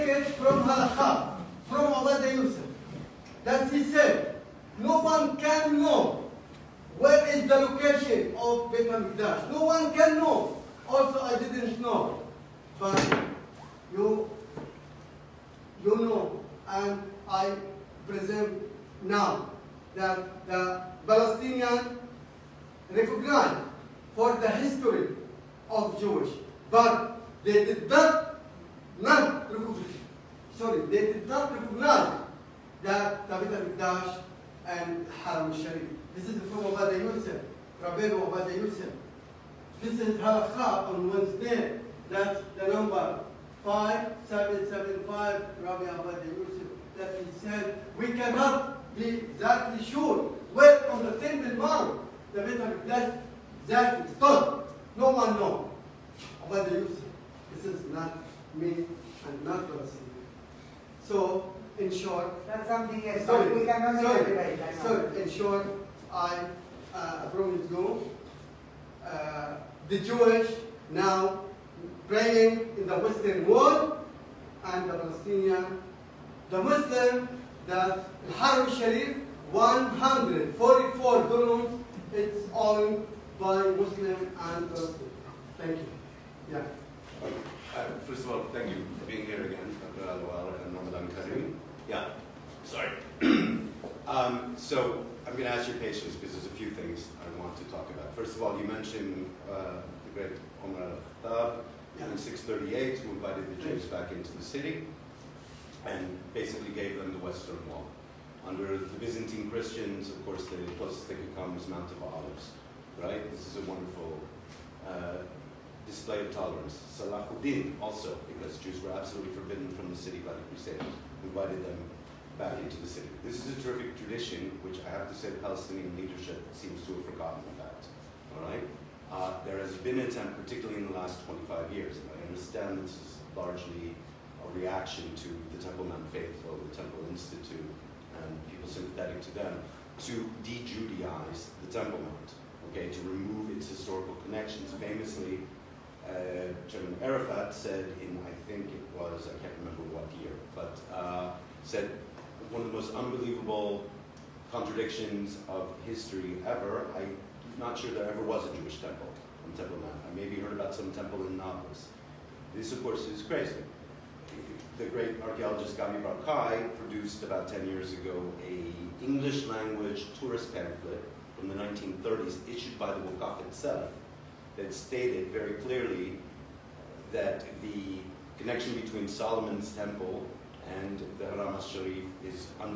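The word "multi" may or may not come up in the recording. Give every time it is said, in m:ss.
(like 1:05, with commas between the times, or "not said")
not said.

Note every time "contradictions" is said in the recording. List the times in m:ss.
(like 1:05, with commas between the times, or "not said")
2:34.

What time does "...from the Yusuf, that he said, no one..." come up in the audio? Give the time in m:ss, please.
0:01.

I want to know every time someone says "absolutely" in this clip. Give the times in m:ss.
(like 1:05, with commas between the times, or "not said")
1:58.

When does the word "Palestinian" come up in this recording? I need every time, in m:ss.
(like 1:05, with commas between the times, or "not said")
0:21, 1:14, 1:24, 2:05.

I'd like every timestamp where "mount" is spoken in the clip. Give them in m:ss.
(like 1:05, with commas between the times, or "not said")
0:51, 1:51, 2:15, 2:21, 2:39.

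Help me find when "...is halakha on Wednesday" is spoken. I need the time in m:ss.
0:39.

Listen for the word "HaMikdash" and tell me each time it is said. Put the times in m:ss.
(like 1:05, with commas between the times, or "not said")
0:08, 0:33, 0:52.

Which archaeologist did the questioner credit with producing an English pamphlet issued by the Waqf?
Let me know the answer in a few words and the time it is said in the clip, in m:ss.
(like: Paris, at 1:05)
Gabi Barkai, at 2:45.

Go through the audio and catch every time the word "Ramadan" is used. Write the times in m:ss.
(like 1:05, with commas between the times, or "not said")
1:30.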